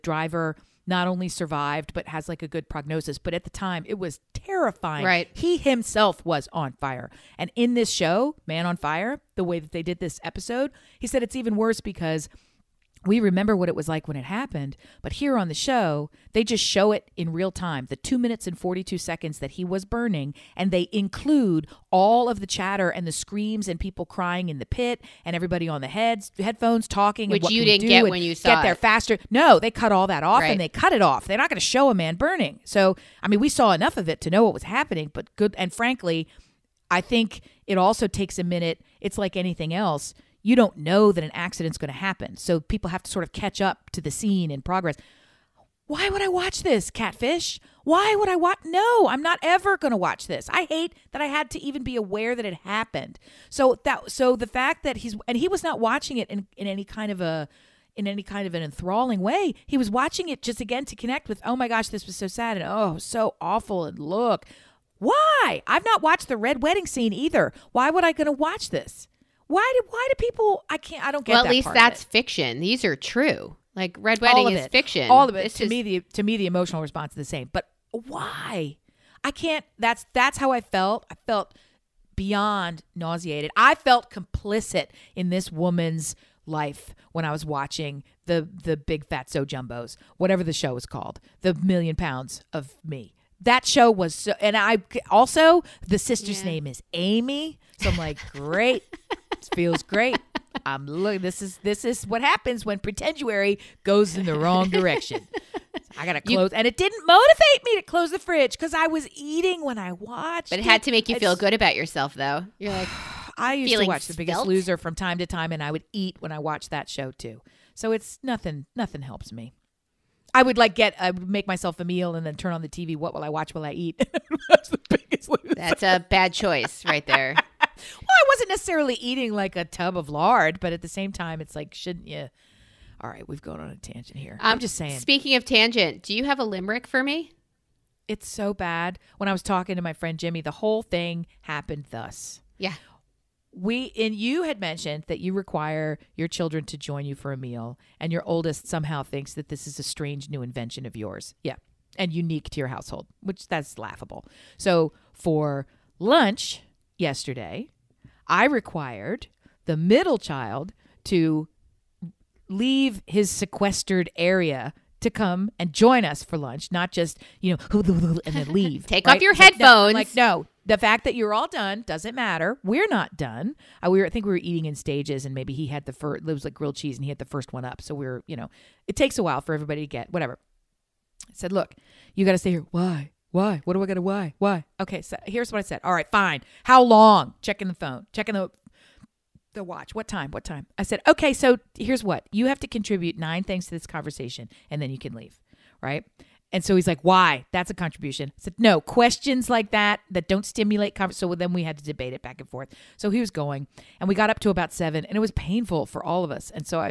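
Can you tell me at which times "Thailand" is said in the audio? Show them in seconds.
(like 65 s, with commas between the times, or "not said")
not said.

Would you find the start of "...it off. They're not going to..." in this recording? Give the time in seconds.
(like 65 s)
30 s.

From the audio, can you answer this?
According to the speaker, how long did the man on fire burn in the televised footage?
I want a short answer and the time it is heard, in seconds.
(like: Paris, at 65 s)
2 minutes 42 seconds, at 17 s.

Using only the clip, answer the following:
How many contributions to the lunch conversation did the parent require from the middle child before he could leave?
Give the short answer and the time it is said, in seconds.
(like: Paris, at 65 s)
9, at 193 s.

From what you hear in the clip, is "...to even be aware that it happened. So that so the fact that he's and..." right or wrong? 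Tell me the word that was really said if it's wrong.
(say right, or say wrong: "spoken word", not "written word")
right.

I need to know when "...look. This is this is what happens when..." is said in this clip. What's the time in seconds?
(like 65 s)
100 s.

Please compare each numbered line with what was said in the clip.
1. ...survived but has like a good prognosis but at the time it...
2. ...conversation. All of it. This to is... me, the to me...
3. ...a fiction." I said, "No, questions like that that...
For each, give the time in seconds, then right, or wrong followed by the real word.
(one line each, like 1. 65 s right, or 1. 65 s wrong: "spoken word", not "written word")
1. 1 s right
2. 74 s wrong: "fiction", not "conversation"
3. 197 s wrong: "contribution", not "fiction".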